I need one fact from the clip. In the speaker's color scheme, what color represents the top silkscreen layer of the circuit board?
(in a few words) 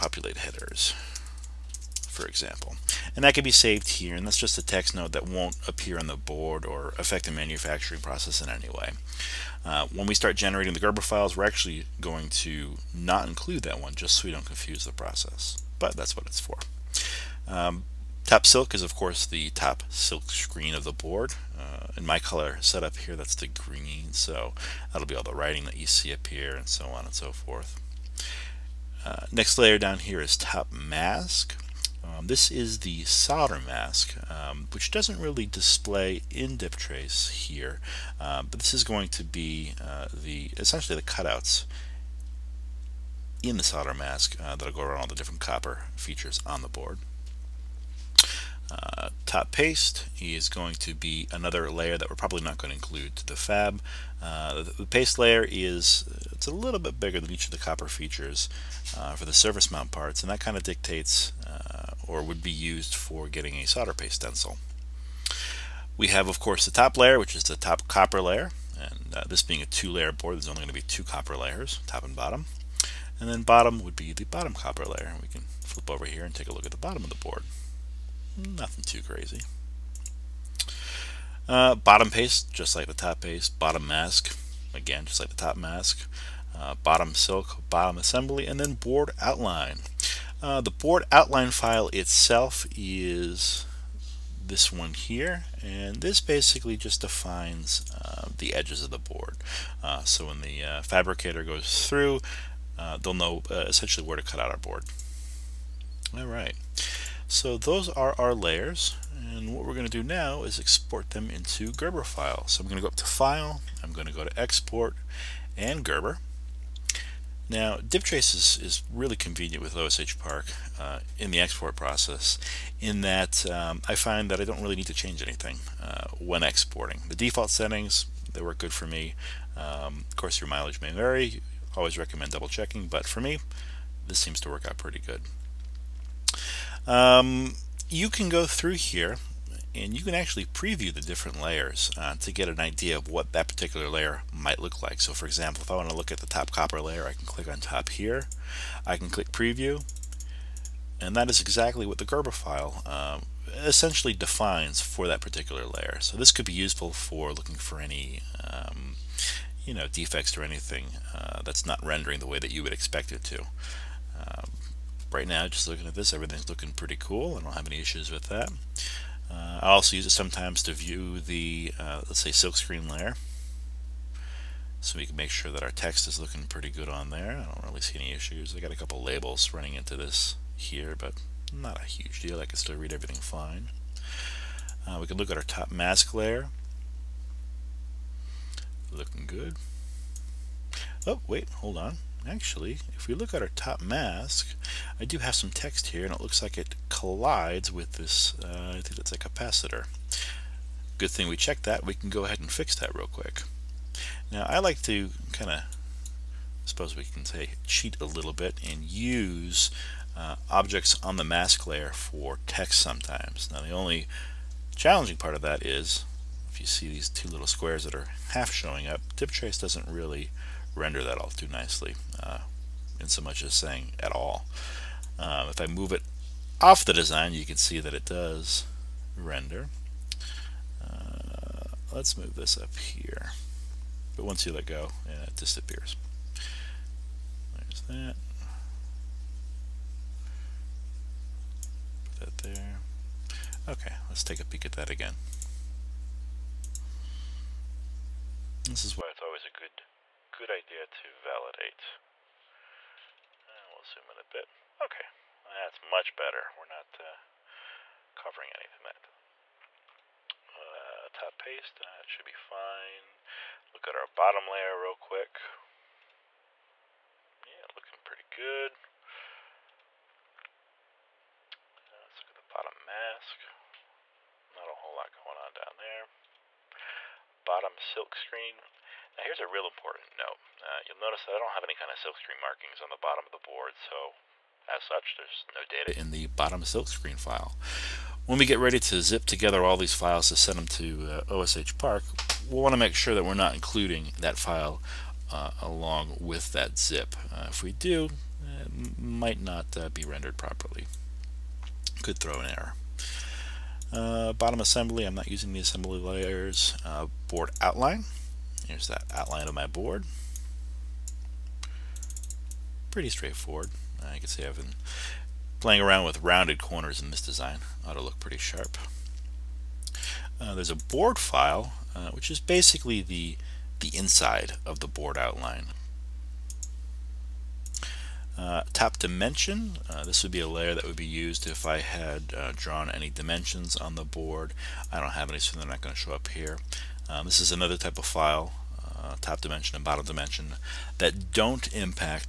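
Green.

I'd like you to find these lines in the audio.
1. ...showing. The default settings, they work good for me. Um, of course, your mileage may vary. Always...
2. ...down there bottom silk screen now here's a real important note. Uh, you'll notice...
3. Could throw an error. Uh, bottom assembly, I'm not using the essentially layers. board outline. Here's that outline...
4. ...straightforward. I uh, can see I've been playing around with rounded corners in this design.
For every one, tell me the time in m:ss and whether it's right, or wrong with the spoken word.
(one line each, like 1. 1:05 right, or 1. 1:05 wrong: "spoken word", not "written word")
1. 2:06 wrong: "exporting", not "showing"
2. 4:35 right
3. 5:02 wrong: "assembly", not "essentially"
4. 5:13 right.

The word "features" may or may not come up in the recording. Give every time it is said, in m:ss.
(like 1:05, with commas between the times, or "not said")
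0:45, 0:57.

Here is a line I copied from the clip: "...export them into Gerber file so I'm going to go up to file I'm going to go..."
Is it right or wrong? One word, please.
right.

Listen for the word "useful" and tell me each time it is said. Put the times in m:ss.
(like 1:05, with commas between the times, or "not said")
2:36.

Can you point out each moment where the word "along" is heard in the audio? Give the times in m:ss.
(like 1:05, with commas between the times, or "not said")
4:55.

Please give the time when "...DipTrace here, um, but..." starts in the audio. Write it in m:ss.
0:36.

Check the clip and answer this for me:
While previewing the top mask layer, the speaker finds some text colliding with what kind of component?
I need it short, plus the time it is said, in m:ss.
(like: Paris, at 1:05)
A capacitor, at 3:19.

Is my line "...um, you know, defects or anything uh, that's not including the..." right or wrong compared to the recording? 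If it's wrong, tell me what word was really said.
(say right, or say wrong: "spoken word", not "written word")
wrong: "rendering", not "including".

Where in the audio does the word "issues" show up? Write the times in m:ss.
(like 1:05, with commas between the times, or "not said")
2:47, 2:58.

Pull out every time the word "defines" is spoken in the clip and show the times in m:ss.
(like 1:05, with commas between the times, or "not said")
1:37, 2:34.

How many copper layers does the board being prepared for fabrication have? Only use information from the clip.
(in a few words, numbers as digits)
2.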